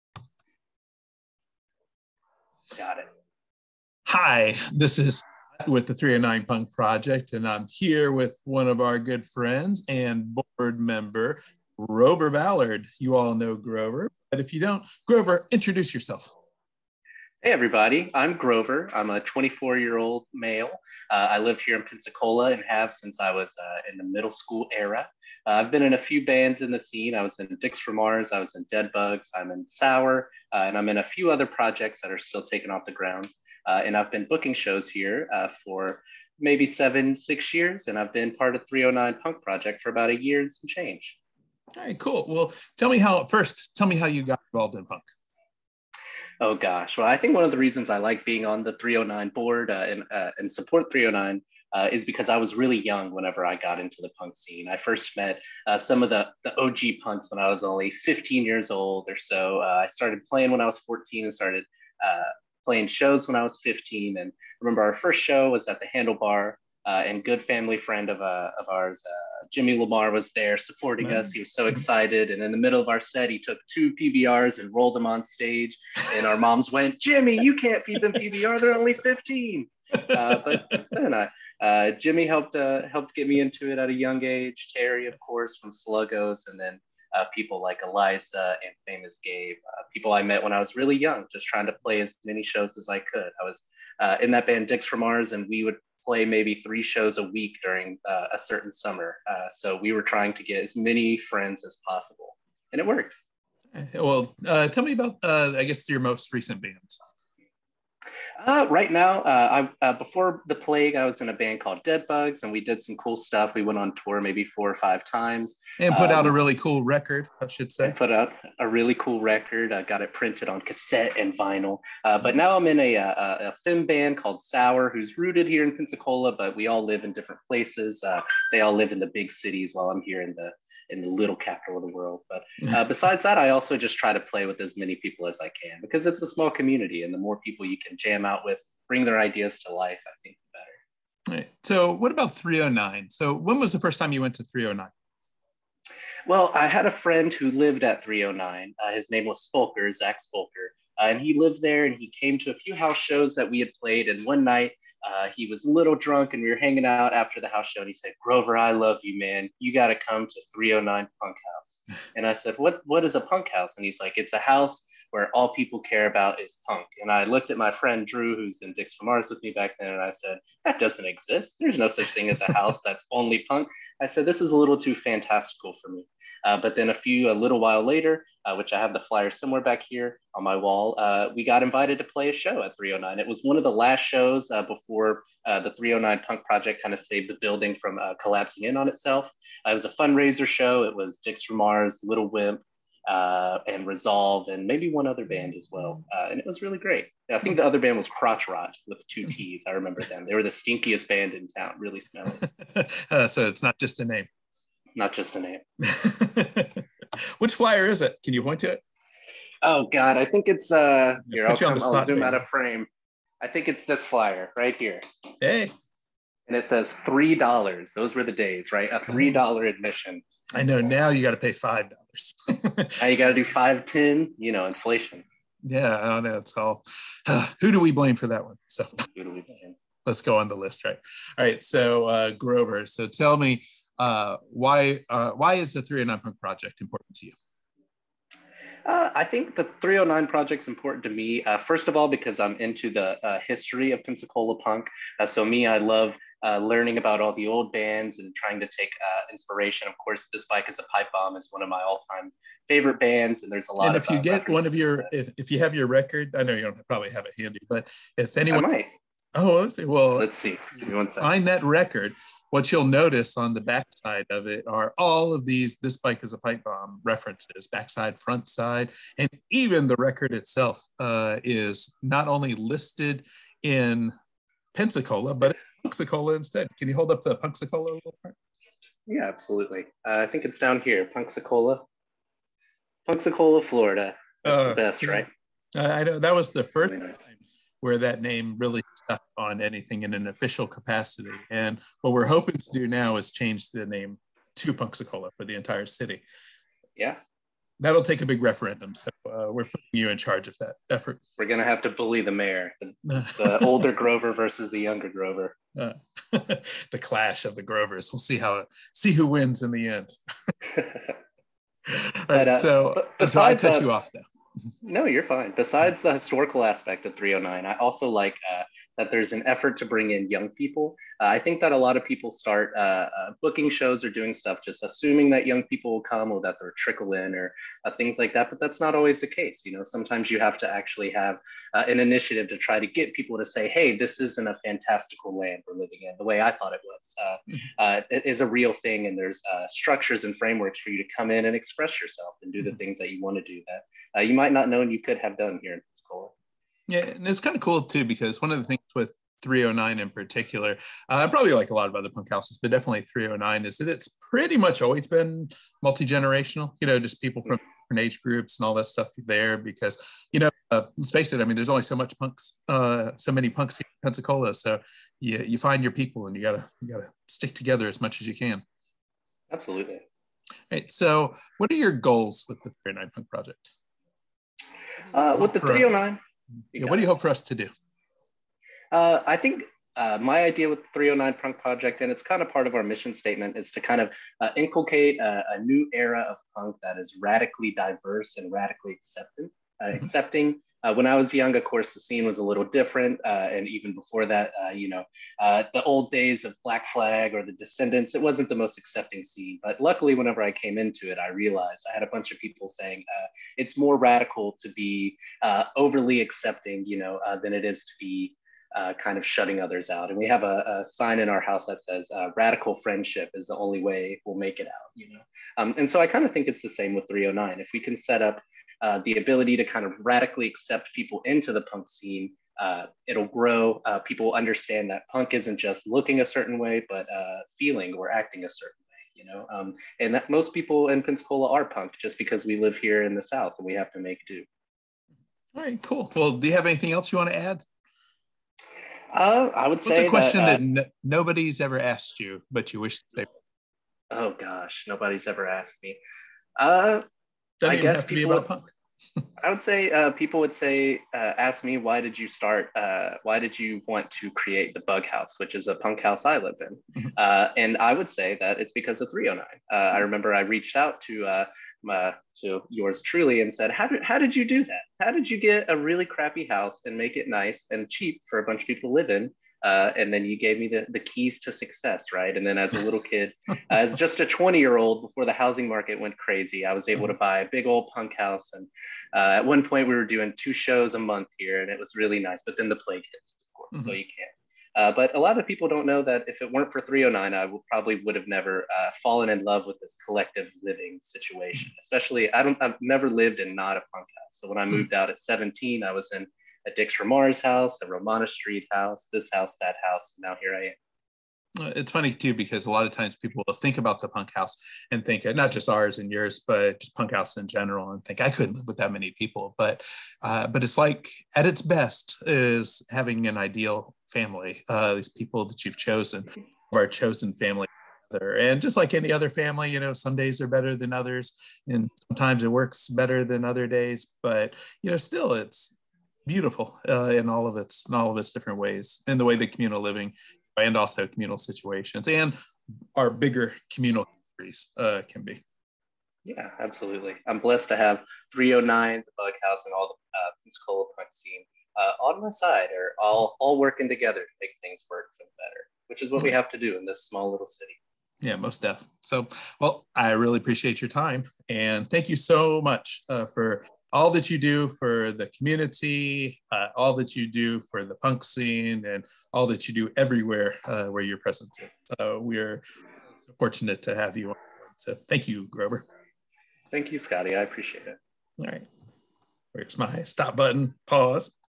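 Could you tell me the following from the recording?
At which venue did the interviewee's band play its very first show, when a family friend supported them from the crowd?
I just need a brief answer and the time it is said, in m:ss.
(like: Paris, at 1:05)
The Handlebar, at 1:05.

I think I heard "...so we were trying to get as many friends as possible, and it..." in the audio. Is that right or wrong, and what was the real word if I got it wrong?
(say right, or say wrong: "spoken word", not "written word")
right.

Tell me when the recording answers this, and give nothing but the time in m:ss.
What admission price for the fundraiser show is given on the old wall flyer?
3:37.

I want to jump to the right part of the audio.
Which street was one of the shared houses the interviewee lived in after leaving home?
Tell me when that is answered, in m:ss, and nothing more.
8:17.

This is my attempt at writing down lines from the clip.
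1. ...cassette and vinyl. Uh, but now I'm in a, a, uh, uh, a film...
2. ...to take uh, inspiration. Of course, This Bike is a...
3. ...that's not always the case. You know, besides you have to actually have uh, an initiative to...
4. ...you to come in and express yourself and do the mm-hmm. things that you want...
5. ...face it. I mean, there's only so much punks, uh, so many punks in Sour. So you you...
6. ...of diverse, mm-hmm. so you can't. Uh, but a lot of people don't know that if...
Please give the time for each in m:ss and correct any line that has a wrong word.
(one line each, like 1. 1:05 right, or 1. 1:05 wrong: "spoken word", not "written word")
1. 2:00 right
2. 4:08 right
3. 5:28 wrong: "sometimes", not "besides"
4. 5:40 right
5. 6:01 wrong: "Pensacola", not "Sour"
6. 8:03 wrong: "course", not "diverse".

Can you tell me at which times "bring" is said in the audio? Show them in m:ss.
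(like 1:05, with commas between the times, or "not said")
2:18, 5:19.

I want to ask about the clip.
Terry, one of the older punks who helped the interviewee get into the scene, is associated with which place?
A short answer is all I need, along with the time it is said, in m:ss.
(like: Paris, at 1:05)
Sluggos, at 1:25.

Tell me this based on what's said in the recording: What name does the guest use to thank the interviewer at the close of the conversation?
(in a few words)
Scotty.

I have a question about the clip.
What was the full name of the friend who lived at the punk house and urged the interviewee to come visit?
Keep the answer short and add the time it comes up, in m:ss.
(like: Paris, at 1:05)
Zach Spolker, at 2:29.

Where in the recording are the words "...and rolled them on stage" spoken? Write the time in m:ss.
1:14.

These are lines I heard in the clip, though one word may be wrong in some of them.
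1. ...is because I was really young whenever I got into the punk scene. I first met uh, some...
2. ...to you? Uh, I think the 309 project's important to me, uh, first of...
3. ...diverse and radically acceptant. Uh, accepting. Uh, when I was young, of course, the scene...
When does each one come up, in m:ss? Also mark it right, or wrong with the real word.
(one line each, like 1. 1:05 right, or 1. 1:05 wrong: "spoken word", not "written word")
1. 0:51 right
2. 3:57 right
3. 6:27 right.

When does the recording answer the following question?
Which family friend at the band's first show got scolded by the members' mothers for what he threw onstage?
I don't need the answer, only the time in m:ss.
1:09.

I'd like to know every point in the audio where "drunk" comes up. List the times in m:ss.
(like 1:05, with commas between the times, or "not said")
2:35.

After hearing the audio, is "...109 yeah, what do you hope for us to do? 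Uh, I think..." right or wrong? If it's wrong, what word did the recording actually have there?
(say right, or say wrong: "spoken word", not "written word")
wrong: "309", not "109".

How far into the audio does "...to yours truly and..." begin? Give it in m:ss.
7:42.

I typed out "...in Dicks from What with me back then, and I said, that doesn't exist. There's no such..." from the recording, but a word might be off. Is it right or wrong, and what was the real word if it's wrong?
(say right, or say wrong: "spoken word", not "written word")
wrong: "Mars", not "What".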